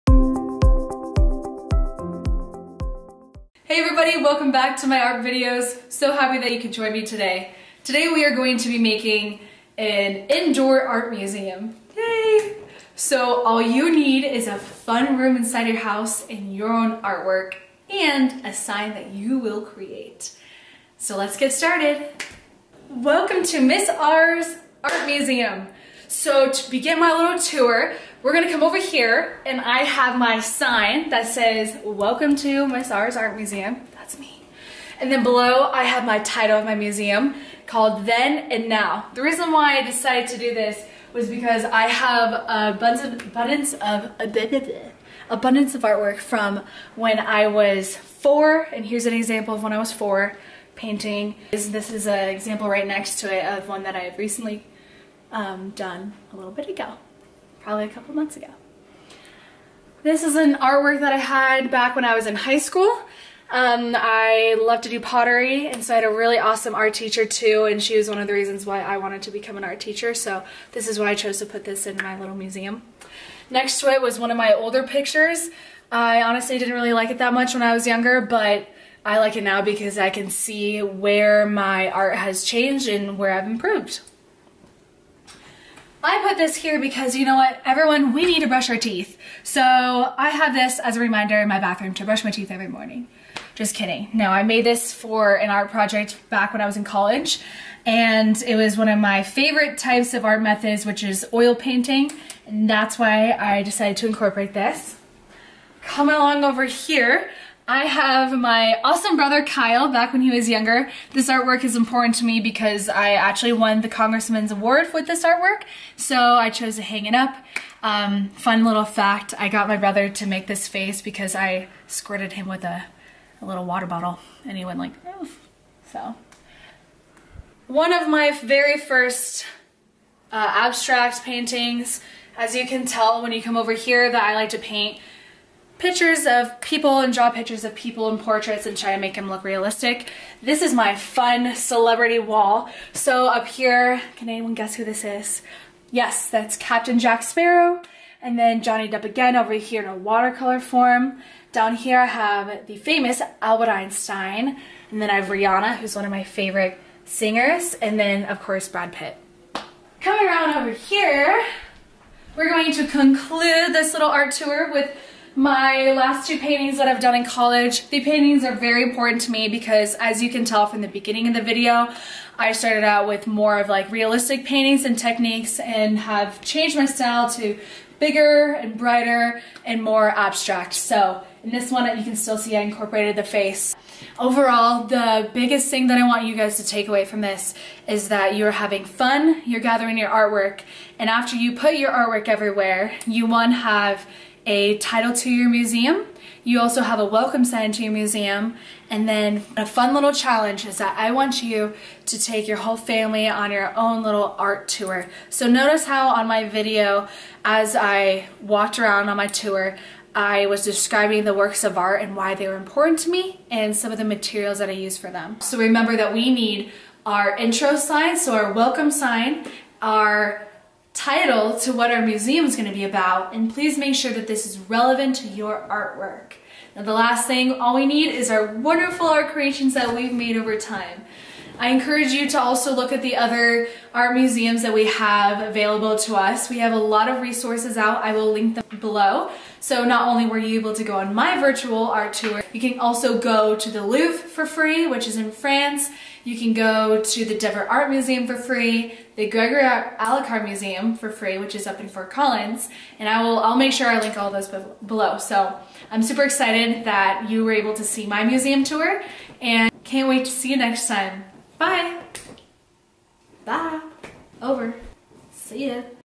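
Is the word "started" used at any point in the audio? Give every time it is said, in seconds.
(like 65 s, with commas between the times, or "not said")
21 s, 172 s.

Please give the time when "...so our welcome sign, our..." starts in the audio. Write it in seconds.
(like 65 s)
218 s.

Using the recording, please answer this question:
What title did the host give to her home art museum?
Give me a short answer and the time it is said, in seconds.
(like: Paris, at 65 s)
Then and Now, at 38 s.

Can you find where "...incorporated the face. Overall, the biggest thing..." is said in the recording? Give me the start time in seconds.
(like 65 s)
182 s.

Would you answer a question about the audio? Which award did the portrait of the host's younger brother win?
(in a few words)
Congressman's Award.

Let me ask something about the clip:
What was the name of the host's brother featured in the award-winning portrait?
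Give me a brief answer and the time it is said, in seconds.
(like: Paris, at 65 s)
Kyle, at 109 s.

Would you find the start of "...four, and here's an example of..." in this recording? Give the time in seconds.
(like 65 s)
47 s.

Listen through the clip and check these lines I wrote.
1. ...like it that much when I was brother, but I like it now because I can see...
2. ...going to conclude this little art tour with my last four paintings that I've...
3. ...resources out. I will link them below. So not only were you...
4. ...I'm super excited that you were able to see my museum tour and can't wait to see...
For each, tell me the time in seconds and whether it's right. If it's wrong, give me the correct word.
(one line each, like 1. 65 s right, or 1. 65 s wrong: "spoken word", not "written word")
1. 76 s wrong: "younger", not "brother"
2. 162 s wrong: "two", not "four"
3. 237 s right
4. 255 s right.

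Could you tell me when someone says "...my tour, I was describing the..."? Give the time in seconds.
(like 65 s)
209 s.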